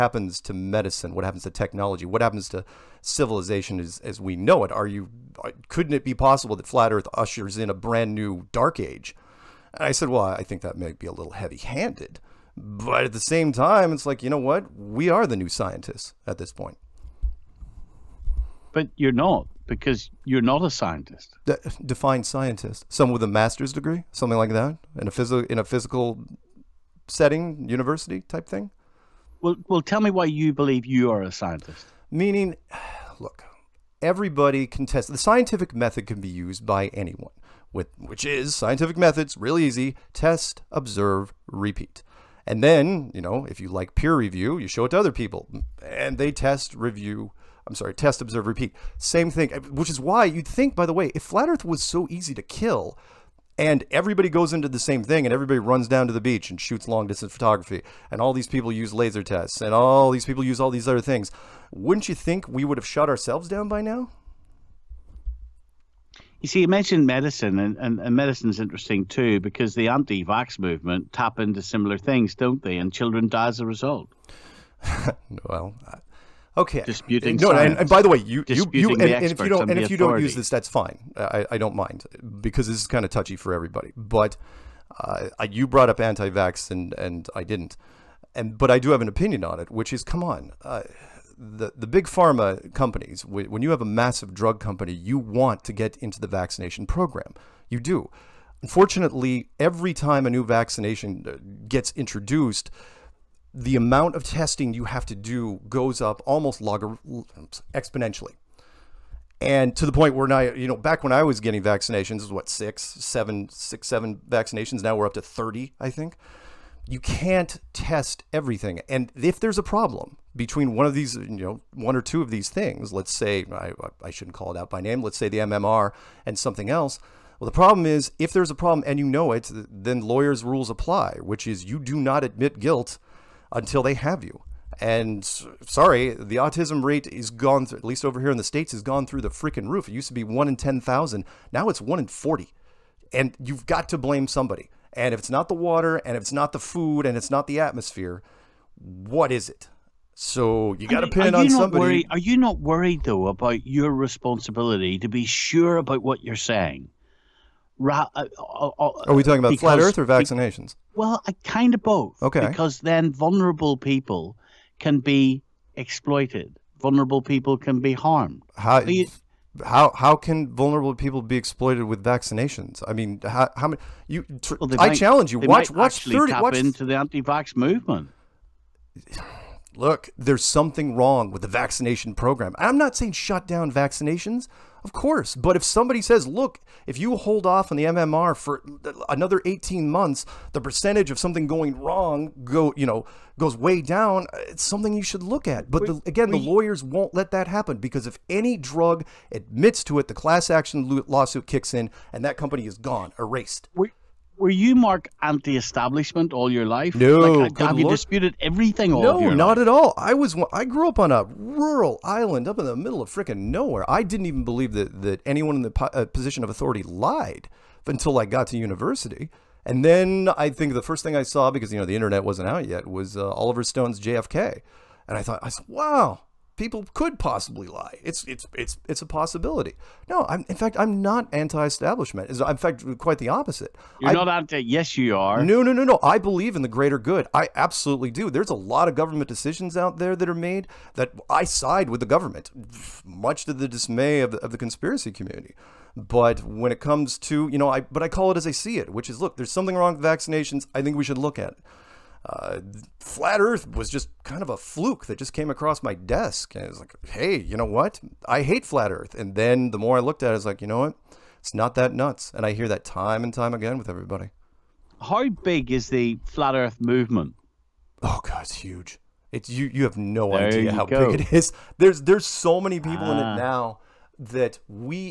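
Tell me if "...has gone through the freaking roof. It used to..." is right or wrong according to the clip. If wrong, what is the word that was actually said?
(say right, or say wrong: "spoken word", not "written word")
right.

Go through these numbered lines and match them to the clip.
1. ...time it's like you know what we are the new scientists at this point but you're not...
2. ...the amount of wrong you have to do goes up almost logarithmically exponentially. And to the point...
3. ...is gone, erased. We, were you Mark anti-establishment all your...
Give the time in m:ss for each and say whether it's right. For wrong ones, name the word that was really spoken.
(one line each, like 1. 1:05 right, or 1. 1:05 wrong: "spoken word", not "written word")
1. 0:13 right
2. 1:43 wrong: "testing", not "wrong"
3. 3:22 right.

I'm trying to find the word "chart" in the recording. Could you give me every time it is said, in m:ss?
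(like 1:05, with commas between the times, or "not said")
not said.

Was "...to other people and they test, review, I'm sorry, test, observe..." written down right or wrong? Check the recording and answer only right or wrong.
right.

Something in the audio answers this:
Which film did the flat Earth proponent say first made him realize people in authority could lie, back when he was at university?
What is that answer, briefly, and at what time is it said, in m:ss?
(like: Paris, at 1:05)
Oliver Stone's JFK, at 3:43.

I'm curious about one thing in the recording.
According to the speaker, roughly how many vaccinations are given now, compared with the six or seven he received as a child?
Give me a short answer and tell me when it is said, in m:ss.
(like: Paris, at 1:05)
30, at 1:55.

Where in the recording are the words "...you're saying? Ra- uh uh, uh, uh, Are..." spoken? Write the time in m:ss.
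2:36.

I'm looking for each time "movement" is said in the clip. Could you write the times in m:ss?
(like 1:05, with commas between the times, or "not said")
1:10, 2:57, 4:26.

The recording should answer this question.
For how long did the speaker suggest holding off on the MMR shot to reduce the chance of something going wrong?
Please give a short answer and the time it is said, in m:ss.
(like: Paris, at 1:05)
18 months, at 3:09.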